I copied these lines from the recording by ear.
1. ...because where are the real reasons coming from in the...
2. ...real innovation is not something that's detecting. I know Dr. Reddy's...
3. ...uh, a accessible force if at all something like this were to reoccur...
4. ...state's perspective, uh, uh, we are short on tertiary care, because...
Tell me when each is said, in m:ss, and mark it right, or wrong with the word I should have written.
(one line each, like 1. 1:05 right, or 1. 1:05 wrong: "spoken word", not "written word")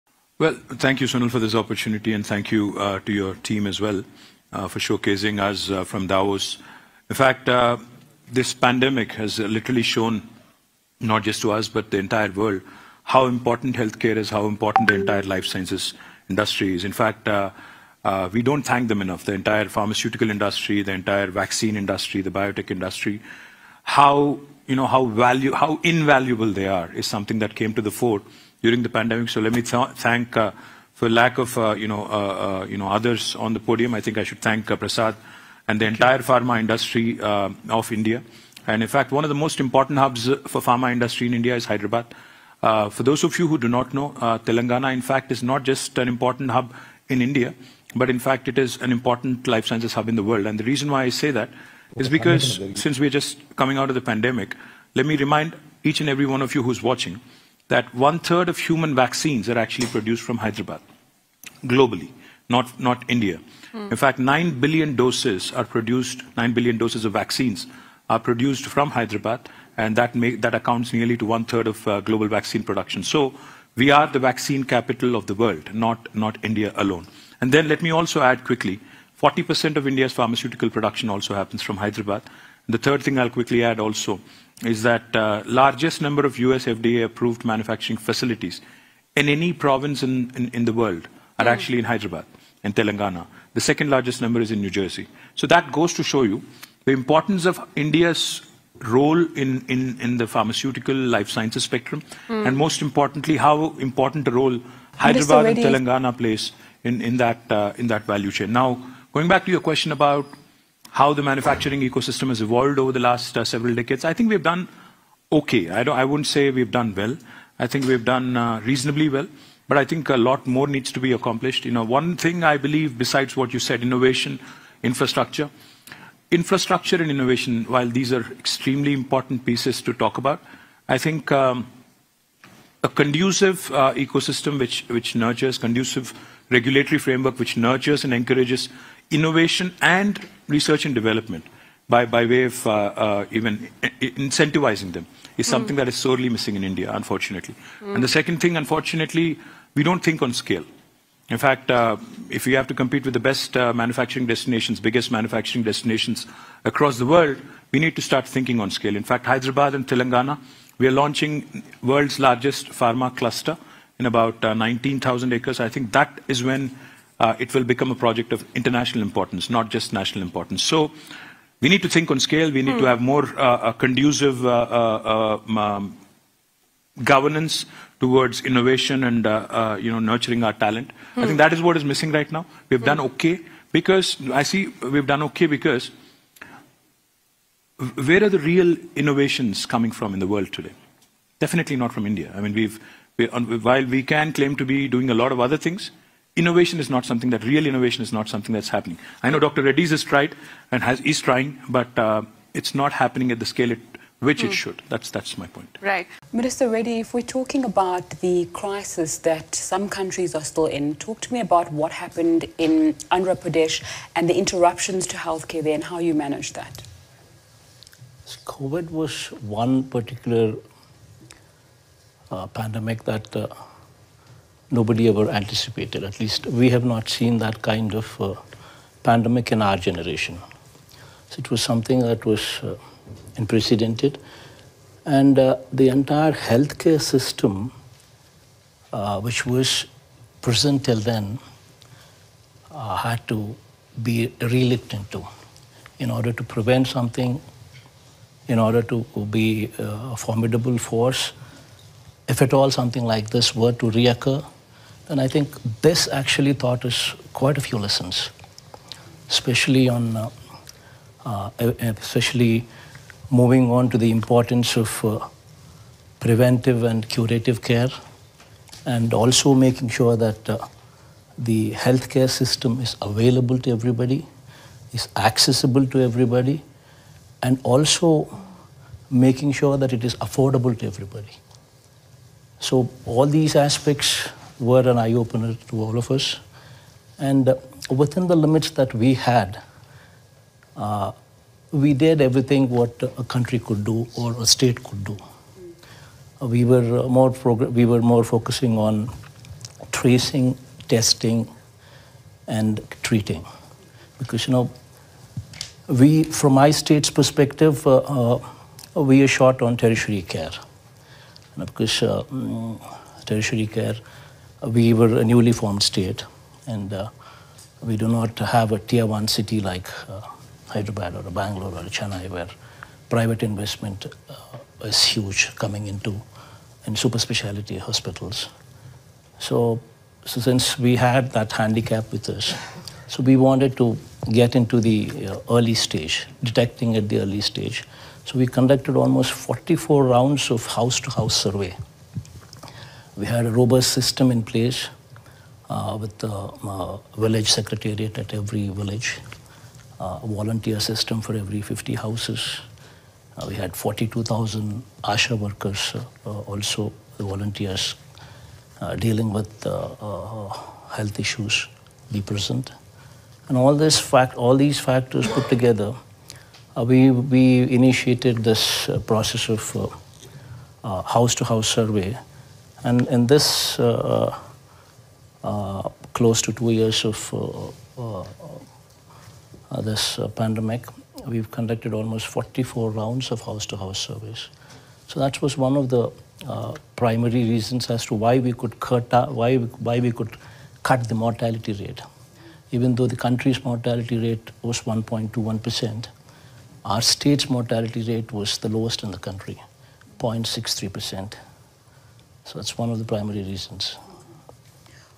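1. 3:05 wrong: "innovations", not "reasons"
2. 3:17 wrong: "happening", not "detecting"
3. 4:09 wrong: "formidable", not "accessible"
4. 5:06 right.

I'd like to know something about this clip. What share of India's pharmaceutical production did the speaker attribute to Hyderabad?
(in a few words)
40%.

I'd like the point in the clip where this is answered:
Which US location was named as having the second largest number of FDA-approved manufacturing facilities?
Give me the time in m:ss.
1:34.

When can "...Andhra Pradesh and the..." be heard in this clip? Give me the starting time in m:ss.
3:33.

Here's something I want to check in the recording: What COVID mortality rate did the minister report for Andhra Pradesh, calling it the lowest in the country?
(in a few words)
0.63 percent.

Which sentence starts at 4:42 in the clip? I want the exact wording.
So all these aspects were an eye opener to all of us.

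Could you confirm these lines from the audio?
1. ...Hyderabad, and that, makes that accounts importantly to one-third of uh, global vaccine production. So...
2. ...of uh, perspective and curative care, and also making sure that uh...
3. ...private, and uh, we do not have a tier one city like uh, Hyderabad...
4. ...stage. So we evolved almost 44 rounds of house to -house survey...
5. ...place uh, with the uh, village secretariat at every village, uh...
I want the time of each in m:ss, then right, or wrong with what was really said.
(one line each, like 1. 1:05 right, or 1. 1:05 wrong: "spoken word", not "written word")
1. 1:08 wrong: "nearly", not "importantly"
2. 4:24 wrong: "preventive", not "perspective"
3. 5:15 wrong: "state", not "private"
4. 5:37 wrong: "conducted", not "evolved"
5. 5:44 right.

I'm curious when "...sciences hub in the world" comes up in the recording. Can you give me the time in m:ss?
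0:49.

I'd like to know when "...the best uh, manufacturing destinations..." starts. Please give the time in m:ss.
2:33.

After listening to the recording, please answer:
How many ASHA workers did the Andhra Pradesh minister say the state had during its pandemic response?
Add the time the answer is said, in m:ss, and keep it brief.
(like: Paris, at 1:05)
42,000, at 5:53.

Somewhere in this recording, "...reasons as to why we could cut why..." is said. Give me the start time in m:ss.
6:27.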